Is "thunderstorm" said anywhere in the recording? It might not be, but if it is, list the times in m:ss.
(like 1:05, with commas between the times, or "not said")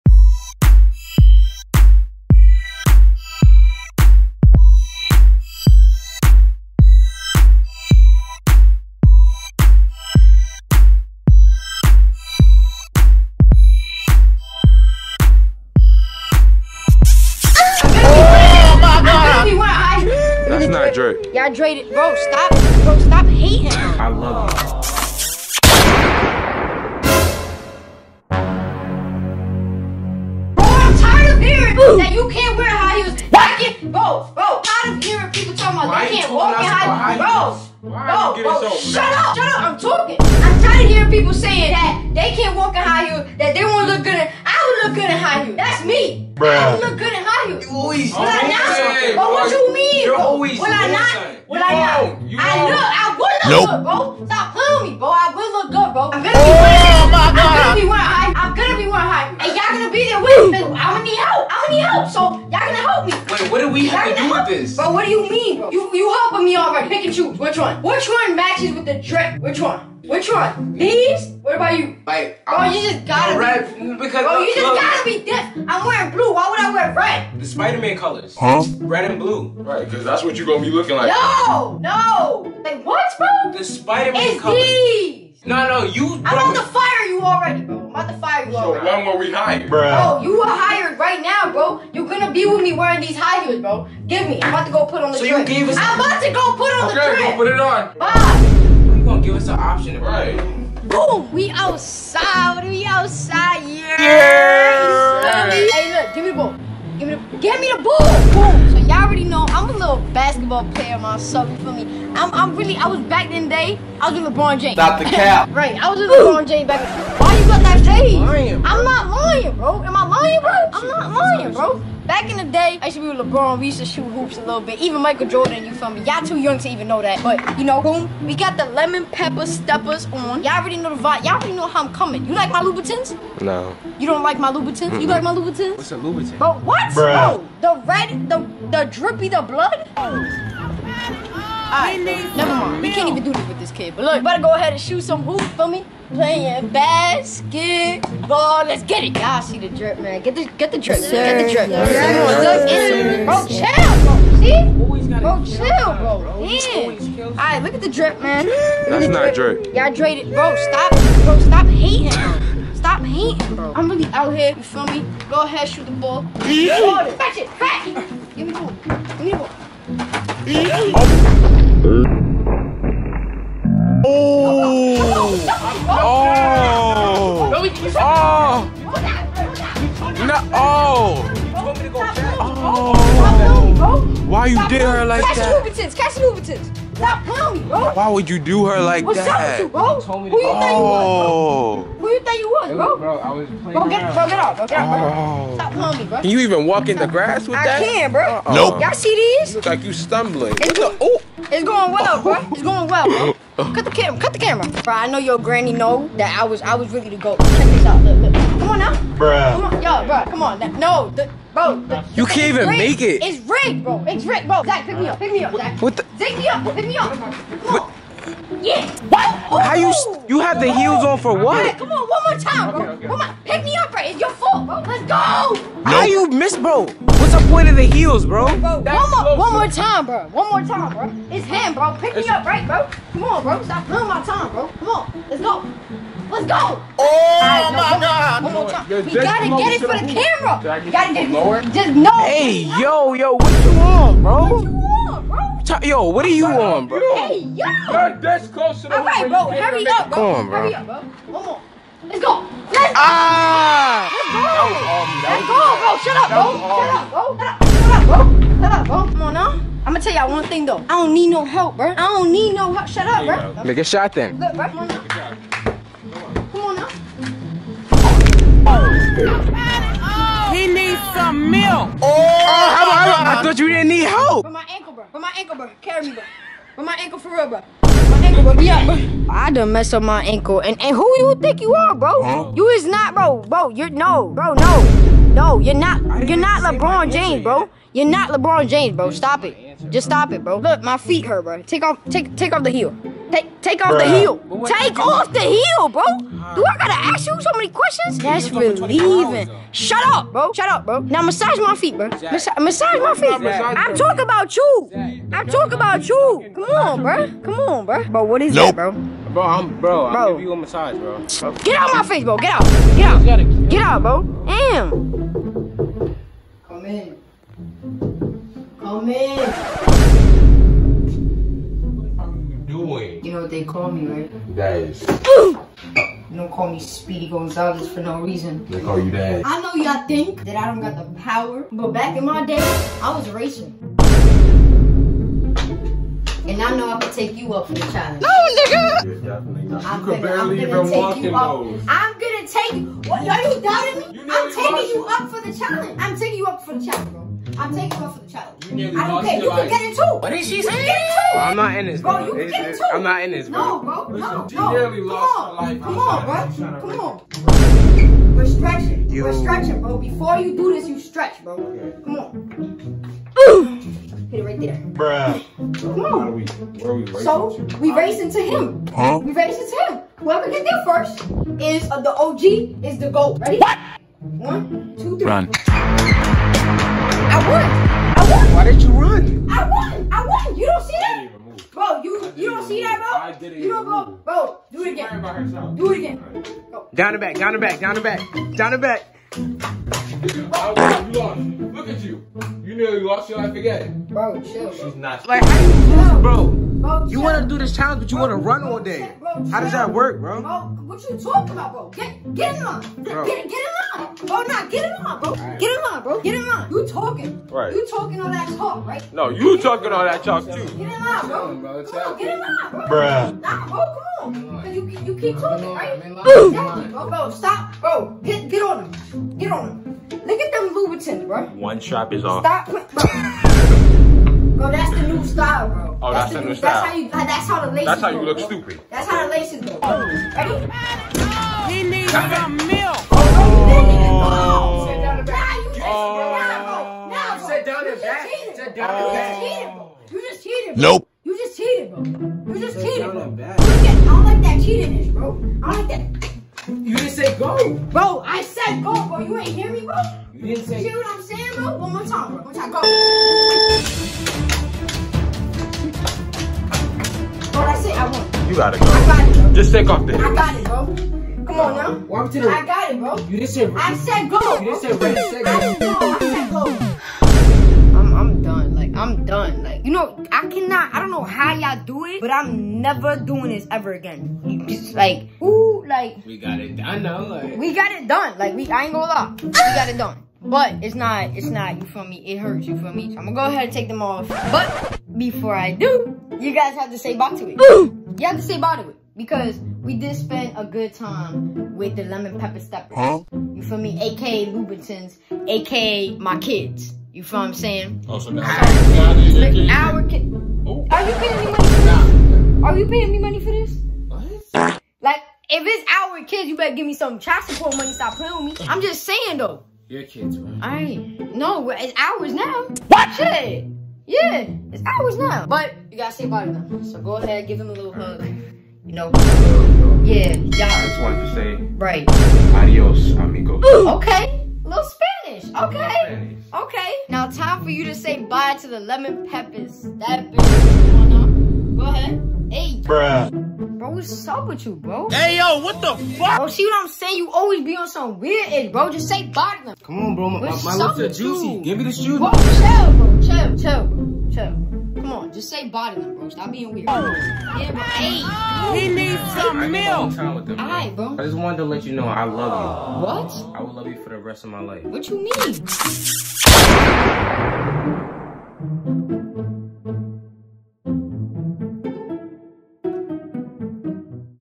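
not said.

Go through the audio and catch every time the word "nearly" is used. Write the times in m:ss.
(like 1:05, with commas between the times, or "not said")
6:32.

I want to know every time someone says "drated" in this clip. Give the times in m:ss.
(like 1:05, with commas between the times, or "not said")
2:39.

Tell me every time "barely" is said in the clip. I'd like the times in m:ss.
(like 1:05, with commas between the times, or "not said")
5:40.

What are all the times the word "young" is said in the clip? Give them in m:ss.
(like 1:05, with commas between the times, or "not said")
2:06.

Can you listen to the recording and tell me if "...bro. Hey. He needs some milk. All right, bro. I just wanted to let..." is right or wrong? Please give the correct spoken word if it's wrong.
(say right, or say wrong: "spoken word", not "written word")
right.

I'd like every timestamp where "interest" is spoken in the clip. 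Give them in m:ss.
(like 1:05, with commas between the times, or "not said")
not said.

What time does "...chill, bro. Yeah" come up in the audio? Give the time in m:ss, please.
2:35.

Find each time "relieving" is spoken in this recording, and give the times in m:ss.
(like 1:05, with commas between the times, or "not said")
4:58.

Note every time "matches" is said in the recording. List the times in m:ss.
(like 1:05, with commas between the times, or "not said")
1:08.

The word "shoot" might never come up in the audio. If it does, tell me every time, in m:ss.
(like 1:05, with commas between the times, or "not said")
2:03, 2:24, 2:45.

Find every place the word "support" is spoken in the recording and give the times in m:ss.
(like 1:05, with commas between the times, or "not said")
8:27.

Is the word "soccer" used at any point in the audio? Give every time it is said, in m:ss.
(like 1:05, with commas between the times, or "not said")
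not said.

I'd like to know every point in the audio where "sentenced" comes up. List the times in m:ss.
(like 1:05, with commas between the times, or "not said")
not said.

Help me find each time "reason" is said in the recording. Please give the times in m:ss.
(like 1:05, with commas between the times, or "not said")
5:28.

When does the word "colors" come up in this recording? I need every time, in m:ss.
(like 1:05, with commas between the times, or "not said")
1:17, 1:24.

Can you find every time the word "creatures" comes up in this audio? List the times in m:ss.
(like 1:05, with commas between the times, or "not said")
not said.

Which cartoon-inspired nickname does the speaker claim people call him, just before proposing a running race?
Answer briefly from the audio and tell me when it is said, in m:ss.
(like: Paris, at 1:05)
Speedy Gonzalez, at 5:26.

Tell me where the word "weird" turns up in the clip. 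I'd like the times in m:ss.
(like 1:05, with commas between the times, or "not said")
8:58, 9:06.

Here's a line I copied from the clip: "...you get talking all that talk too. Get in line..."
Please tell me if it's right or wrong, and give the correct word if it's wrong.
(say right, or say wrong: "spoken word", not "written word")
right.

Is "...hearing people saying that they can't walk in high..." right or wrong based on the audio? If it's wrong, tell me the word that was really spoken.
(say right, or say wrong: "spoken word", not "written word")
right.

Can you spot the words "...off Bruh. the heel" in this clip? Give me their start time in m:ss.
4:53.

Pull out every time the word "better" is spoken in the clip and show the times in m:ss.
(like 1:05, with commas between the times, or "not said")
2:24, 8:26.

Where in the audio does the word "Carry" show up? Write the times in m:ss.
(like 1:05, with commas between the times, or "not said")
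4:35.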